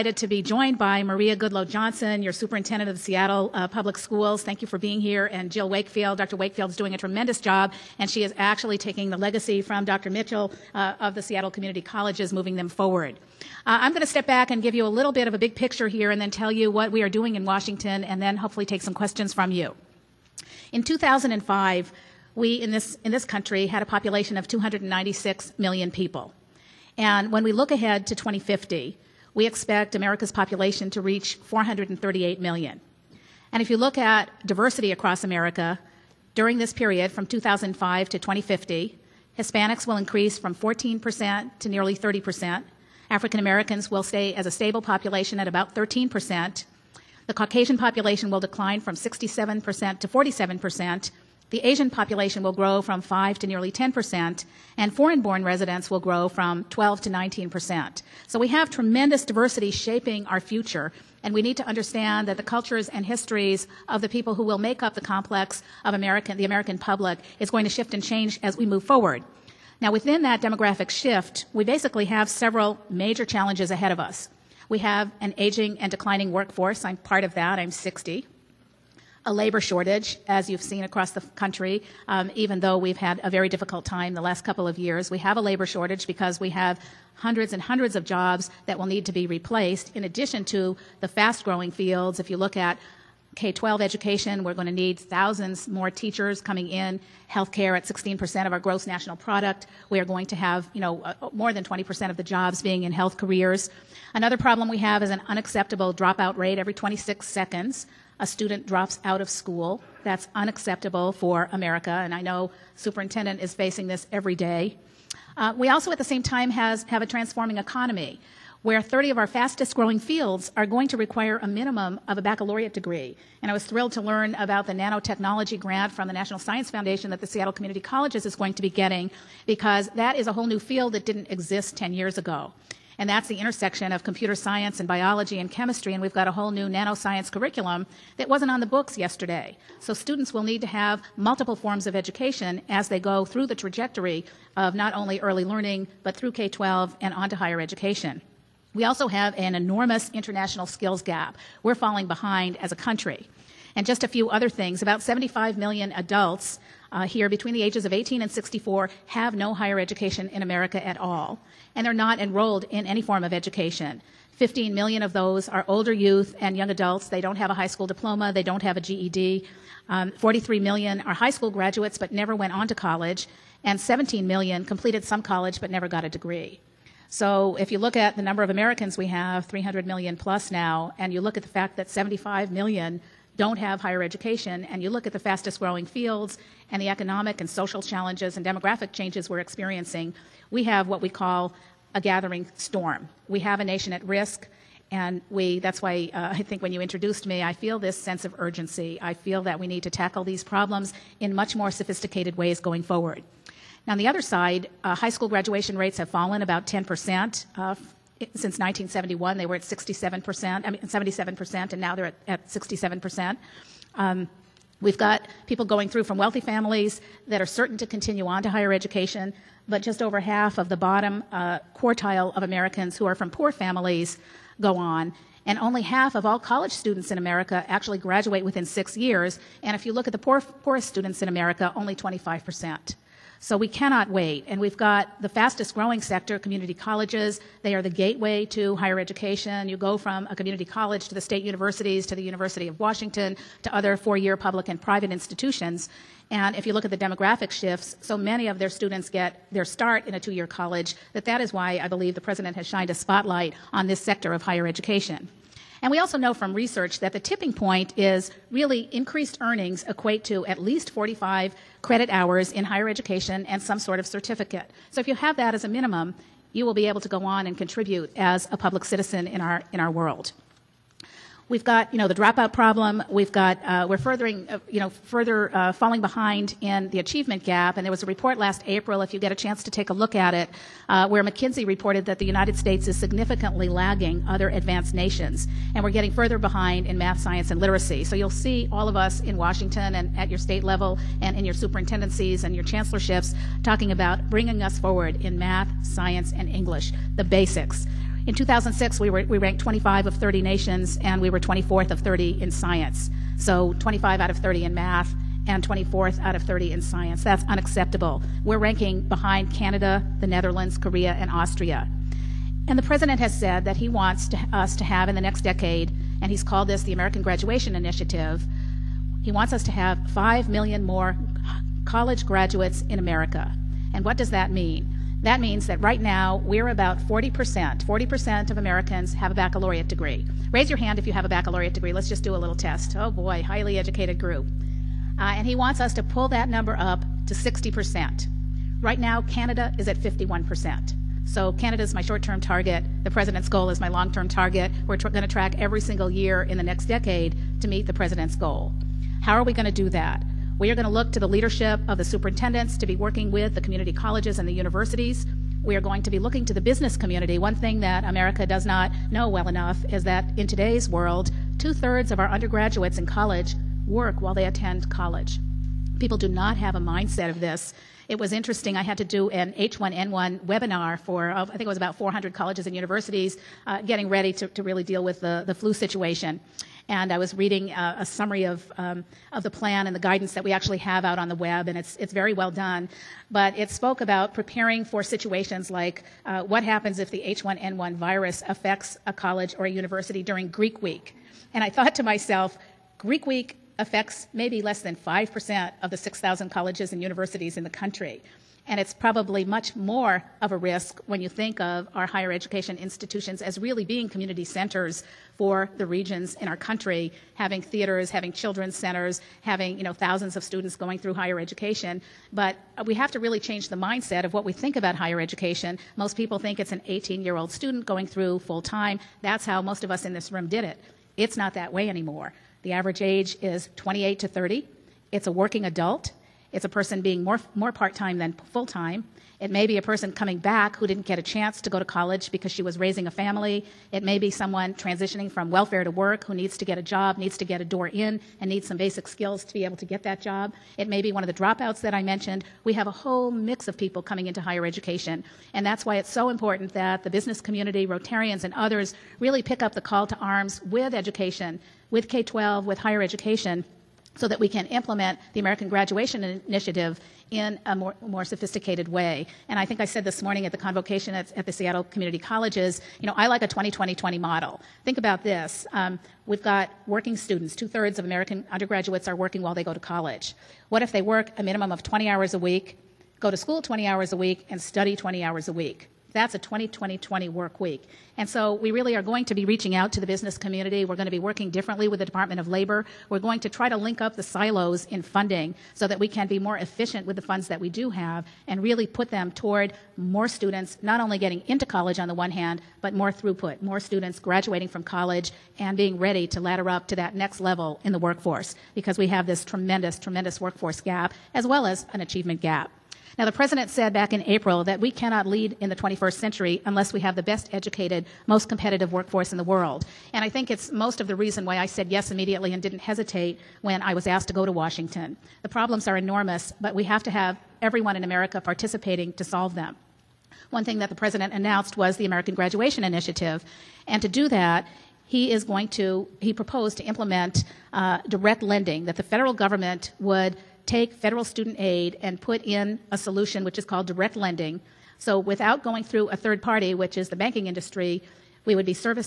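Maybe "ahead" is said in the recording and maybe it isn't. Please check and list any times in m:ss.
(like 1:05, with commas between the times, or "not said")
0:27, 1:13.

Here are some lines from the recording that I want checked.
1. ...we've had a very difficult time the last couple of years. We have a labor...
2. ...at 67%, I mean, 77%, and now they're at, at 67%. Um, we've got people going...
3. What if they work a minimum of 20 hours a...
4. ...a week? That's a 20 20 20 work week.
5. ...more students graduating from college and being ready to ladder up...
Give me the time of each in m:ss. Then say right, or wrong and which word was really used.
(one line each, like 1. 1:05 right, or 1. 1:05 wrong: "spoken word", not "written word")
1. 1:22 right
2. 3:29 right
3. 7:50 right
4. 7:55 right
5. 8:13 right.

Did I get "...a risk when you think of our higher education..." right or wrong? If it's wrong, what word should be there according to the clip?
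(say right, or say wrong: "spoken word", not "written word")
right.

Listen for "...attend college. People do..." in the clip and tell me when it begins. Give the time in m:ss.
6:04.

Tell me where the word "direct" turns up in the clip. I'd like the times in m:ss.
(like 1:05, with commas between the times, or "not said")
8:48, 8:53.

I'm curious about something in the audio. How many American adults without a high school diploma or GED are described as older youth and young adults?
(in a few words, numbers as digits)
15 million.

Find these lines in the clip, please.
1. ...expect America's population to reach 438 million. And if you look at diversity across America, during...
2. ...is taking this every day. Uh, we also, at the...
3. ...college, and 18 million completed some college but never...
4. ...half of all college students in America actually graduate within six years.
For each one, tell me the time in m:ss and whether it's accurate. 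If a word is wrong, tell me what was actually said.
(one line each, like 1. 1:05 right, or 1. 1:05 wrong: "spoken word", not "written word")
1. 0:29 right
2. 1:53 wrong: "facing", not "taking"
3. 2:52 wrong: "17", not "18"
4. 3:45 right.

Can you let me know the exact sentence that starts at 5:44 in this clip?
We're tr- going to track every single year in the next decade to meet the president's goal.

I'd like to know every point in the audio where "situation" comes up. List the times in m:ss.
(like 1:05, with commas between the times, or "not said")
6:15, 6:25.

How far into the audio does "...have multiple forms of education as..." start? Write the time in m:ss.
2:20.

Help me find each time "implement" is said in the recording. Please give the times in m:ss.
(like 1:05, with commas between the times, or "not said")
7:34, 8:46.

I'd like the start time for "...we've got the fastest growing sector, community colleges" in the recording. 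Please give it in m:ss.
3:54.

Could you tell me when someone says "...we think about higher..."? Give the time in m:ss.
6:54.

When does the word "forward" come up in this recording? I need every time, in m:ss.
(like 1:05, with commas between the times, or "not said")
0:12, 1:08, 3:22, 4:54.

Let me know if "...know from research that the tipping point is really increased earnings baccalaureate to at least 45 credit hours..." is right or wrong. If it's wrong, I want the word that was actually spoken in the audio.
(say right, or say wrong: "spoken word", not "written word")
wrong: "equate", not "baccalaureate".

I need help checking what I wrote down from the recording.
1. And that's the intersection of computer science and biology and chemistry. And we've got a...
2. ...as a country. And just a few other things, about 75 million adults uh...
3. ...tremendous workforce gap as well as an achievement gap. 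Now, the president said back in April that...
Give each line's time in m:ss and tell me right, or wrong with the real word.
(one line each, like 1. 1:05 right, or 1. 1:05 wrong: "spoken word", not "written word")
1. 2:12 right
2. 2:32 right
3. 8:19 right.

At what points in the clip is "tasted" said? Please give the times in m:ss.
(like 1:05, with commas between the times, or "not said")
not said.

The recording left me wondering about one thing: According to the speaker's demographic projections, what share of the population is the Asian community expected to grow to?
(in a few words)
nearly 10 percent.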